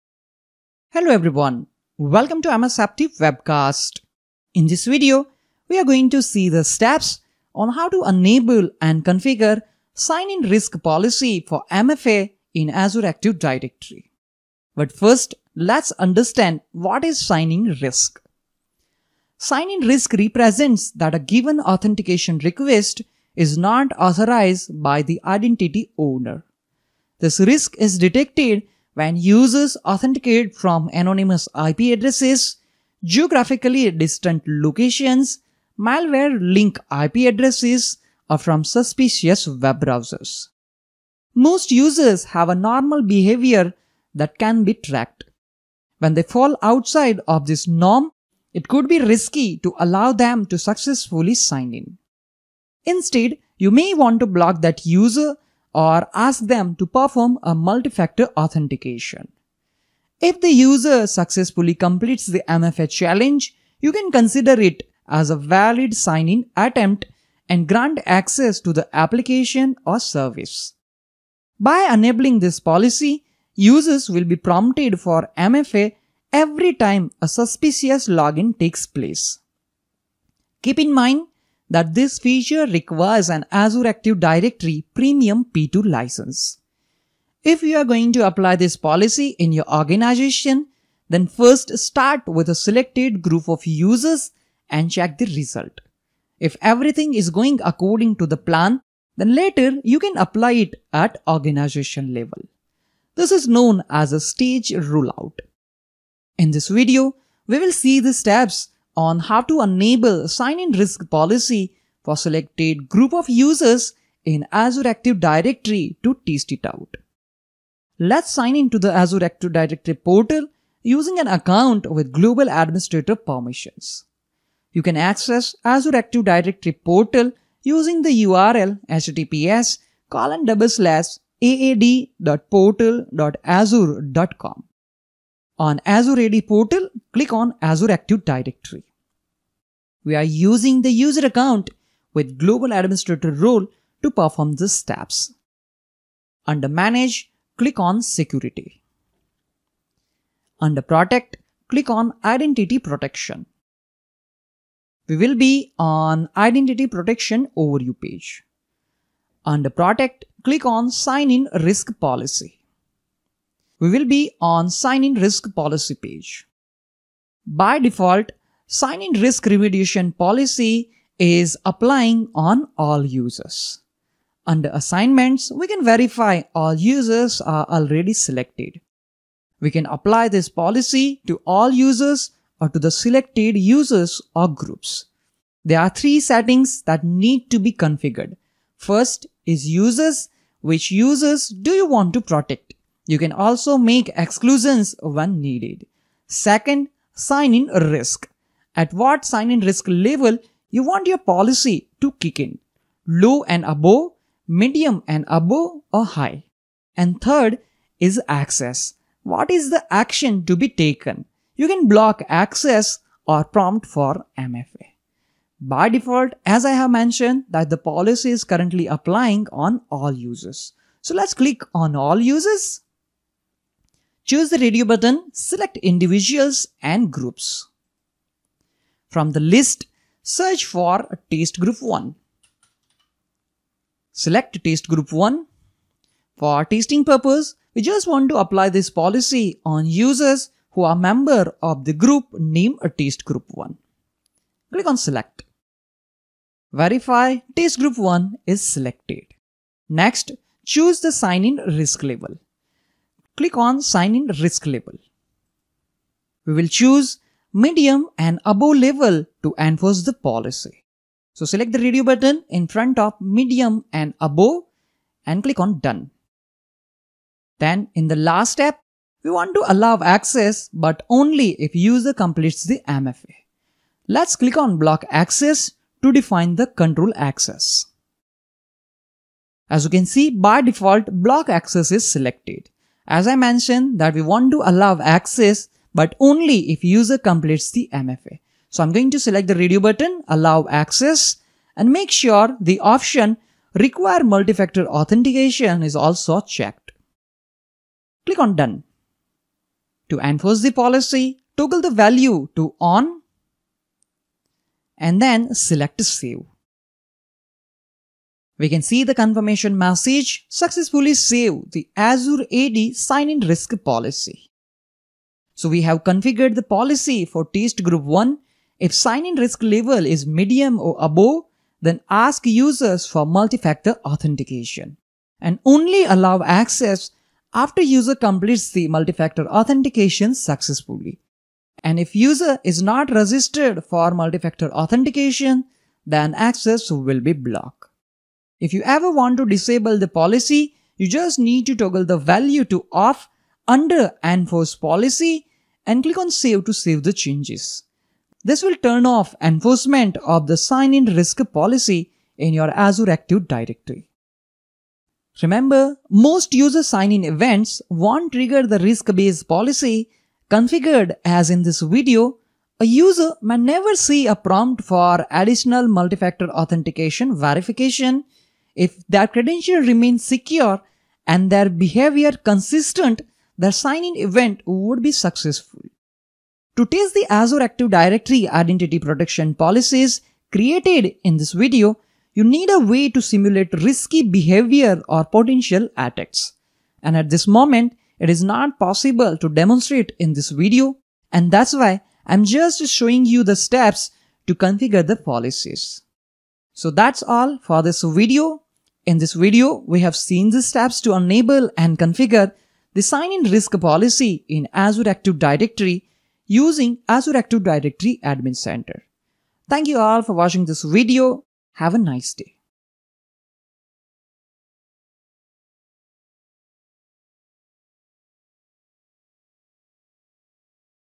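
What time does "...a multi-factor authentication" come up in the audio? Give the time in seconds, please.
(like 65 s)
57 s.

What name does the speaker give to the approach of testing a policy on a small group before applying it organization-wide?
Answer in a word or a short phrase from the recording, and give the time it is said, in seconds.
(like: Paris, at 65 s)
stage rollout, at 104 s.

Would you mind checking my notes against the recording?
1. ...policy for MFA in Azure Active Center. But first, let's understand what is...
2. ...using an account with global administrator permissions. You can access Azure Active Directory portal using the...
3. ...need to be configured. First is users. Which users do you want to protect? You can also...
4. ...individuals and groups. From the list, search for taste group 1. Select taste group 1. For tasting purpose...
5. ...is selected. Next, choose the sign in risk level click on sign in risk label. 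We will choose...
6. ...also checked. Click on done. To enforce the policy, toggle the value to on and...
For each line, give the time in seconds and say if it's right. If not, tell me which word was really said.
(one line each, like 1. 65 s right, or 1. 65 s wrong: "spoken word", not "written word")
1. 10 s wrong: "Directory", not "Center"
2. 120 s right
3. 187 s right
4. 225 s right
5. 248 s right
6. 295 s right.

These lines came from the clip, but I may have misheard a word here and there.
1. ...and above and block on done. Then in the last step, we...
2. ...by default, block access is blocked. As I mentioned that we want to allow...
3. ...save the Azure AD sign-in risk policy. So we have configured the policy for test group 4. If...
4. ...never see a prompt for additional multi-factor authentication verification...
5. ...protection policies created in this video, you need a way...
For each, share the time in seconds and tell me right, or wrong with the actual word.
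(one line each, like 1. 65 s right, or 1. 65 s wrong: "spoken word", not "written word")
1. 263 s wrong: "click", not "block"
2. 280 s wrong: "selected", not "blocked"
3. 311 s wrong: "1", not "4"
4. 363 s right
5. 378 s right.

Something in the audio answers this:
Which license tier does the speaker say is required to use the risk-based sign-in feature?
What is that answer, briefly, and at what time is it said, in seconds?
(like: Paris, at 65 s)
Azure Active Directory Premium P2, at 83 s.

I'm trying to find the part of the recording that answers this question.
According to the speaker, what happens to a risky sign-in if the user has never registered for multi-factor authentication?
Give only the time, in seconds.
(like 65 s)
336 s.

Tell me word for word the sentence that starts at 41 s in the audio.
Most users have a normal behavior that can be tracked.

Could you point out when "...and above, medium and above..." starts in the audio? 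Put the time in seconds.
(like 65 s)
203 s.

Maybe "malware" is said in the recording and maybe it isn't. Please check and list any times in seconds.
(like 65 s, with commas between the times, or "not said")
35 s.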